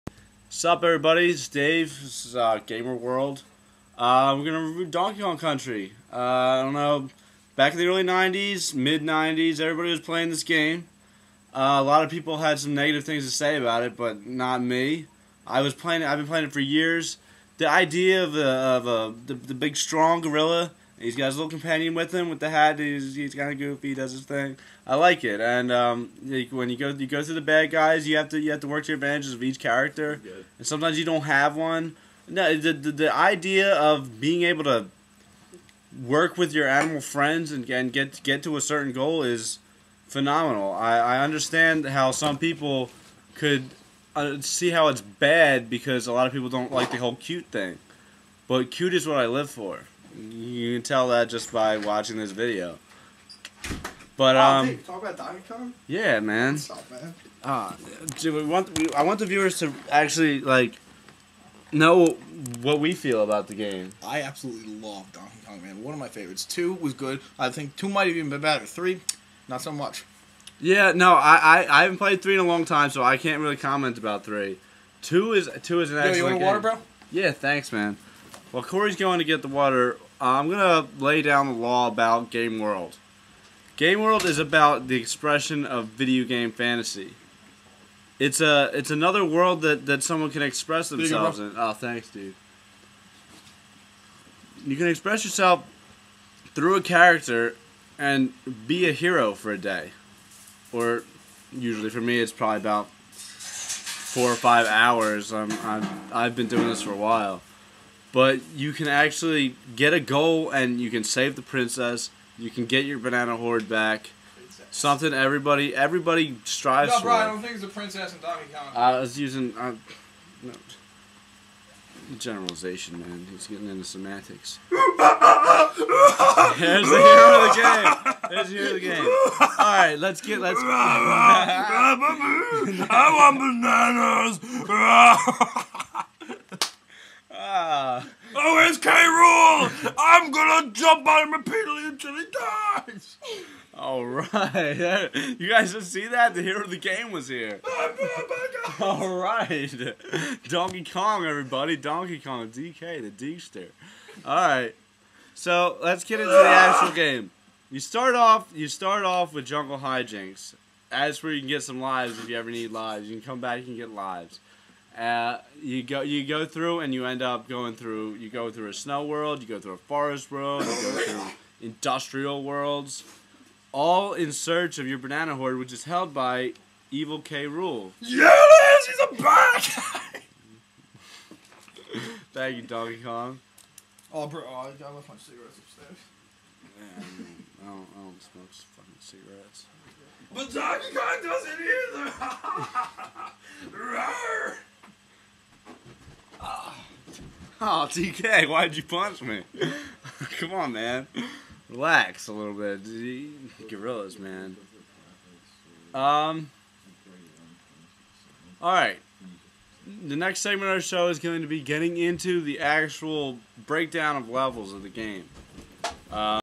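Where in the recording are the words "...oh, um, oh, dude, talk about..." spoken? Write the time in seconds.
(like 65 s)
54 s.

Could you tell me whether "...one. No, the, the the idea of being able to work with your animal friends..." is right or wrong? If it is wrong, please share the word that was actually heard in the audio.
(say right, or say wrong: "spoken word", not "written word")
right.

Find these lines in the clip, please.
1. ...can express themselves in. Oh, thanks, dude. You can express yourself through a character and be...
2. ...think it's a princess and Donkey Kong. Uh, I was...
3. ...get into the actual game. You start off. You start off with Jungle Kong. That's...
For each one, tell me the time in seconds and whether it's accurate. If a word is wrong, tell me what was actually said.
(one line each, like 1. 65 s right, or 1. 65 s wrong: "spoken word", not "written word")
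1. 90 s right
2. 117 s right
3. 156 s wrong: "Hijinxs", not "Kong".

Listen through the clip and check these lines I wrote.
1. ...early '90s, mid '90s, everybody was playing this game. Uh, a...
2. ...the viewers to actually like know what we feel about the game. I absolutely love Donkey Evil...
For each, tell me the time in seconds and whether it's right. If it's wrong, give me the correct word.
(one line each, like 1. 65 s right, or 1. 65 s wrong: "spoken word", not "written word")
1. 7 s right
2. 59 s wrong: "Kong", not "Evil".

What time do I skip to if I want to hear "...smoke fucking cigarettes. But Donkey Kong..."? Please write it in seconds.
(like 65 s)
188 s.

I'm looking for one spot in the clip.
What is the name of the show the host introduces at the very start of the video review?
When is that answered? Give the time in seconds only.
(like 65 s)
2 s.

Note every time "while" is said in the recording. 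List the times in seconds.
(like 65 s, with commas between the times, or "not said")
106 s.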